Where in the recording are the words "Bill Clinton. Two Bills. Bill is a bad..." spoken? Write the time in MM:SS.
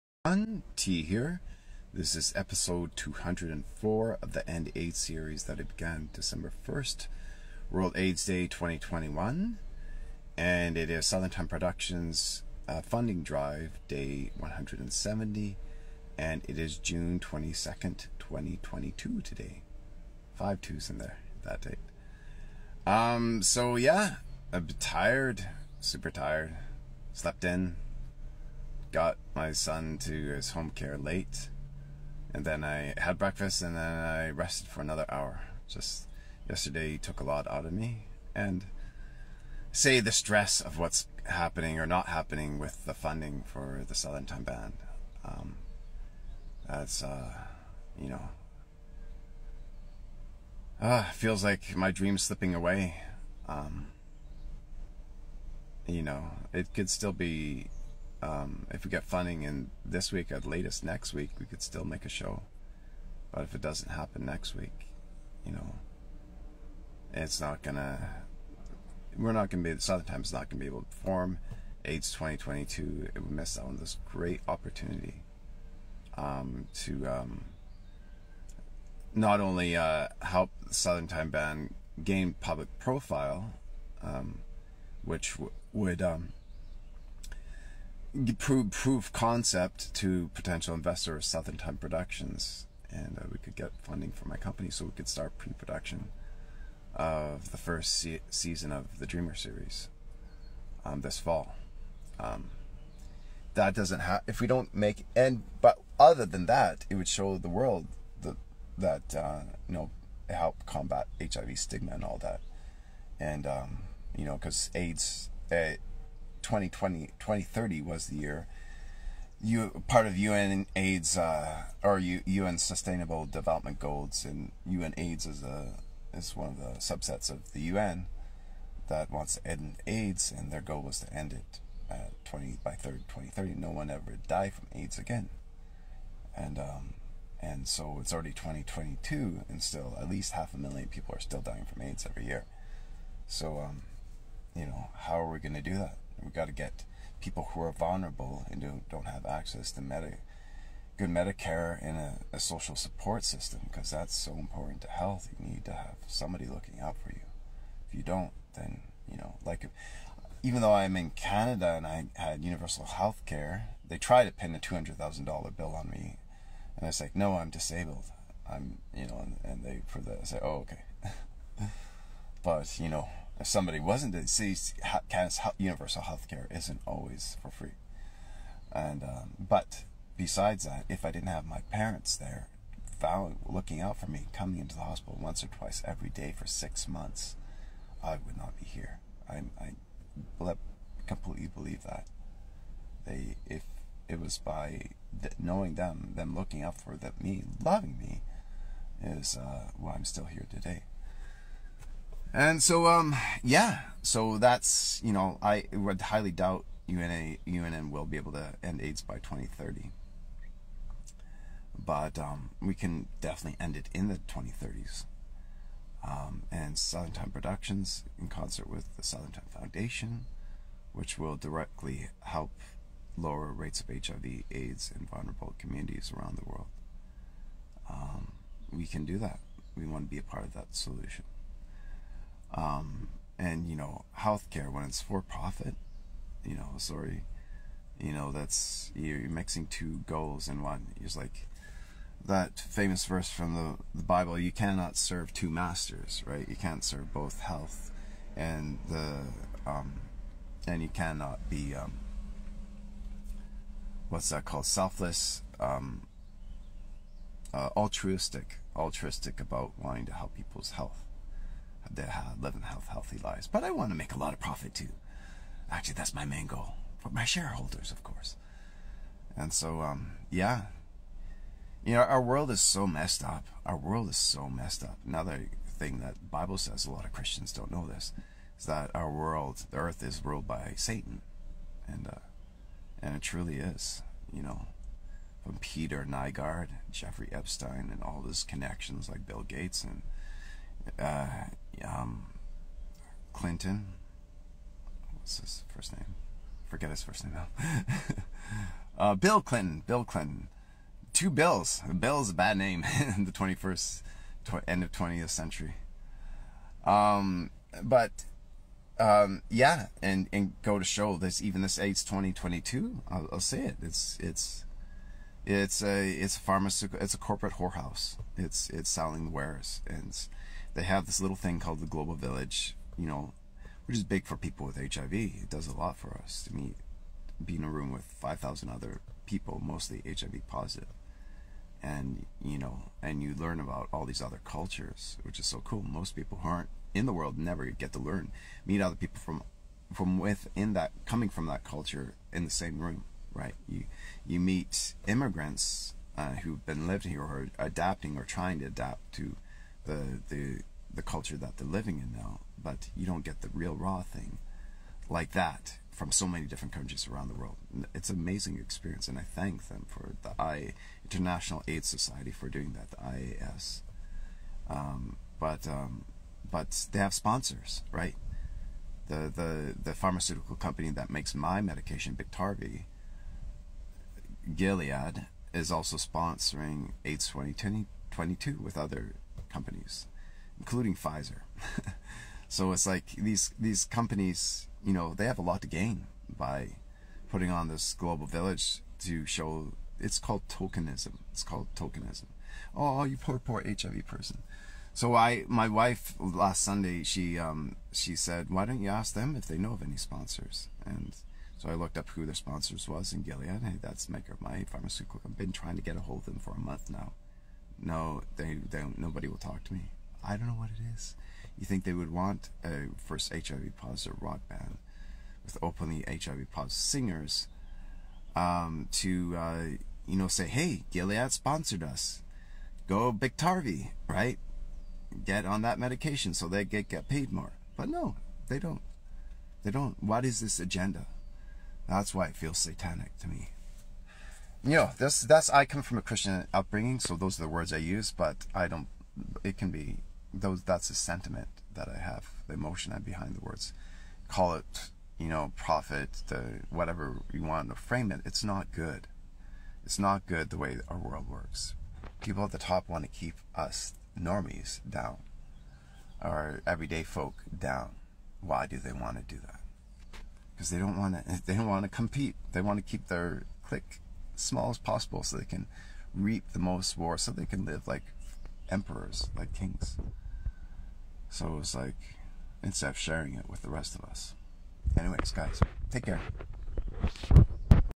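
04:59.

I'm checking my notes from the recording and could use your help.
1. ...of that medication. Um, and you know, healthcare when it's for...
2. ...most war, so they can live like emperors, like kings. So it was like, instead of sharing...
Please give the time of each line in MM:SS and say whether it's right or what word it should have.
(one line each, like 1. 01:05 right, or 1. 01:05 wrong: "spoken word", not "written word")
1. 03:50 wrong: "solution", not "medication"
2. 07:46 right.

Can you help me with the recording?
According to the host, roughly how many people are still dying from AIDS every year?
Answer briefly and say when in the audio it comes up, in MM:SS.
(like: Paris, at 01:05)
half a million, at 02:20.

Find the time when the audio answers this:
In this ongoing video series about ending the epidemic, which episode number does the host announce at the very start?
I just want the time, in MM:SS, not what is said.
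00:02.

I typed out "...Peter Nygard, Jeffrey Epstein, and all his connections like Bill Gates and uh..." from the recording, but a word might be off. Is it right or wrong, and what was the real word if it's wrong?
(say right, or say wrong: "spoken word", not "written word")
right.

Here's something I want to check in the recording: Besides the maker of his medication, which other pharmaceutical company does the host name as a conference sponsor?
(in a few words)
Pfizer.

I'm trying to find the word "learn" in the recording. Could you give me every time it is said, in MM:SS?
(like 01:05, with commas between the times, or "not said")
05:33, 05:37.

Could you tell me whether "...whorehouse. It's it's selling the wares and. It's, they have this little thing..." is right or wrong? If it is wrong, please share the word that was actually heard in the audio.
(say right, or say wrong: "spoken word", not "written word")
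right.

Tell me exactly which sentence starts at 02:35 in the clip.
You need to have somebody looking out for you.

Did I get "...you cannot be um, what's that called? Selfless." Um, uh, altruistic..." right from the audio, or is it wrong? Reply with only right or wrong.
right.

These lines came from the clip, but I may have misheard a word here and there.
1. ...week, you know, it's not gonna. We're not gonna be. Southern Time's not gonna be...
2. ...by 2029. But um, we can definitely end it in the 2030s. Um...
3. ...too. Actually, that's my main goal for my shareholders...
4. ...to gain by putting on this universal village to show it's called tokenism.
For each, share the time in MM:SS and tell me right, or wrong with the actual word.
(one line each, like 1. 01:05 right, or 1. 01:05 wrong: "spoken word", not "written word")
1. 01:04 right
2. 03:29 wrong: "2030", not "2029"
3. 04:24 right
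4. 06:25 wrong: "global", not "universal".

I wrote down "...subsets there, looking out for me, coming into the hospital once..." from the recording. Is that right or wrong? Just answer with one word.
wrong.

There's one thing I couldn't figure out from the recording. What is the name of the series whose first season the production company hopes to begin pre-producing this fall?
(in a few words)
Dreamer.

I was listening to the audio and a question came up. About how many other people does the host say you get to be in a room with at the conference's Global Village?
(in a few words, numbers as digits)
5,000.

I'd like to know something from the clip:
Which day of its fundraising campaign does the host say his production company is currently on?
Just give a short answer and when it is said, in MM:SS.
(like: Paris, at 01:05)
170, at 00:13.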